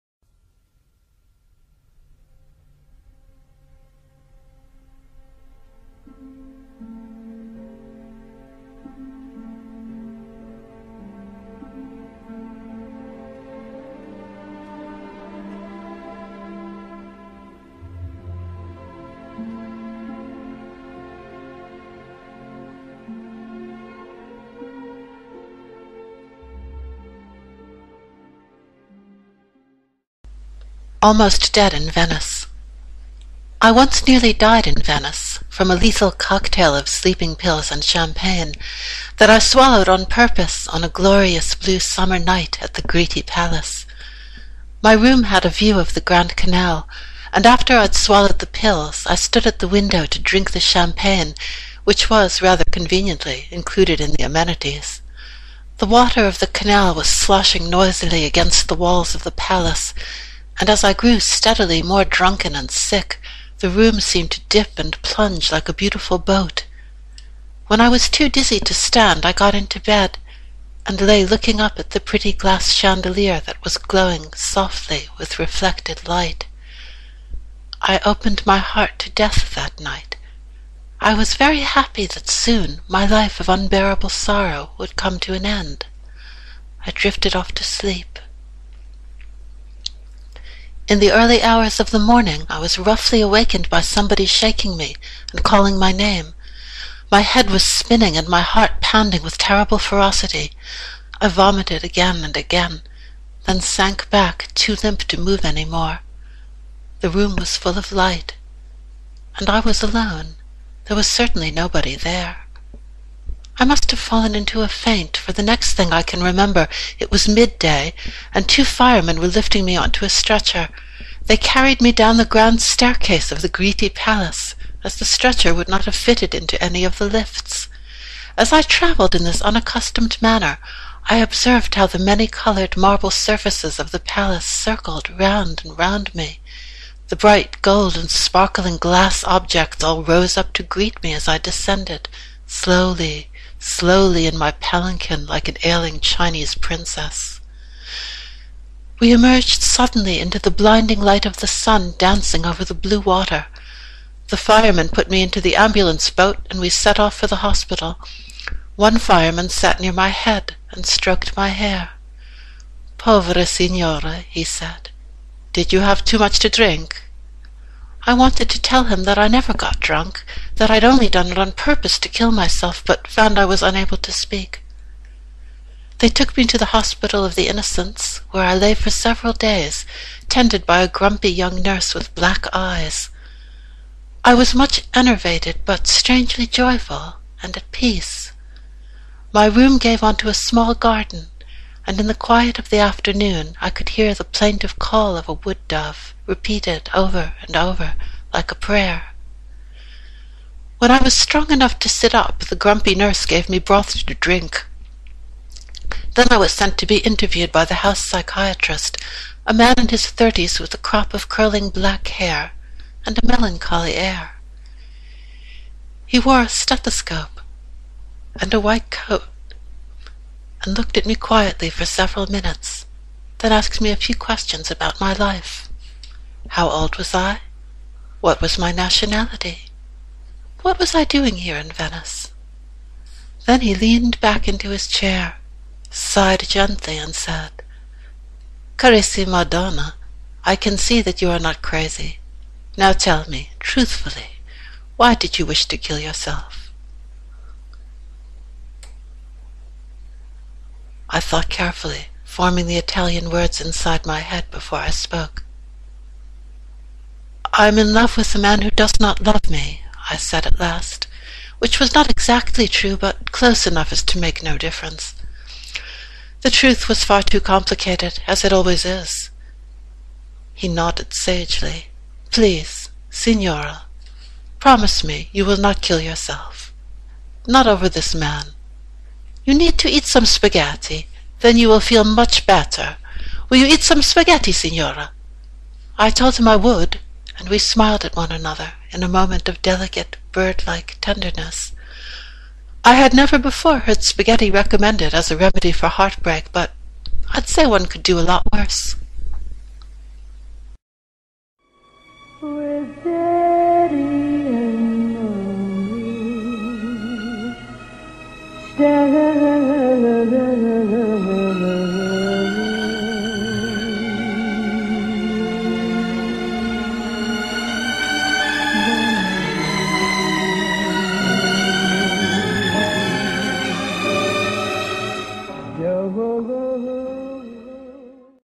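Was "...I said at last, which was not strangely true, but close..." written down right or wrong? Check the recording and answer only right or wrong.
wrong.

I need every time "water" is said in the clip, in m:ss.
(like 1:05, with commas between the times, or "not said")
0:55, 2:32.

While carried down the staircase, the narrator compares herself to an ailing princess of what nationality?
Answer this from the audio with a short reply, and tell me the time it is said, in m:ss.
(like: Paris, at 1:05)
Chinese, at 2:25.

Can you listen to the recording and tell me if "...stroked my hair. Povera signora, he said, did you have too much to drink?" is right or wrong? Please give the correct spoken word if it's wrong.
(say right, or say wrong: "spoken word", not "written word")
right.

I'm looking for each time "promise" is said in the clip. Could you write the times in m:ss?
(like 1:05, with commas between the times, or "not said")
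4:34.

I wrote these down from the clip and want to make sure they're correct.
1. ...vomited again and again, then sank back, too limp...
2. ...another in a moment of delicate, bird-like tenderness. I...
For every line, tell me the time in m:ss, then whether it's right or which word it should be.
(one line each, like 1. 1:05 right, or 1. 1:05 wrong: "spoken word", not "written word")
1. 1:41 right
2. 4:48 right.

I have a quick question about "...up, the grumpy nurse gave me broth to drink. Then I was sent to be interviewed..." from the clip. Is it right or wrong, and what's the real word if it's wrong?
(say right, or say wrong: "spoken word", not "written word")
right.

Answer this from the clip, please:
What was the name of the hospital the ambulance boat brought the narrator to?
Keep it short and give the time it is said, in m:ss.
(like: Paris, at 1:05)
Hospital of the Innocents, at 2:56.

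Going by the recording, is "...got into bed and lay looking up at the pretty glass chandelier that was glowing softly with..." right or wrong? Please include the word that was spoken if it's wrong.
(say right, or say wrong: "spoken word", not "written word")
right.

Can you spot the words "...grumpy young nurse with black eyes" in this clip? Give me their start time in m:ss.
3:00.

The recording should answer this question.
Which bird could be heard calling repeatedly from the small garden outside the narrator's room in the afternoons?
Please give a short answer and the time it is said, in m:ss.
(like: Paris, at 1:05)
wood dove, at 3:15.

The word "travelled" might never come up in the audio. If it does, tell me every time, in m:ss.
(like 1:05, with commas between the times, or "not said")
2:08.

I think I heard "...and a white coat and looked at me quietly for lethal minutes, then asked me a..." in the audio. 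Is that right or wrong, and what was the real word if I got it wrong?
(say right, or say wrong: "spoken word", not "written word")
wrong: "several", not "lethal".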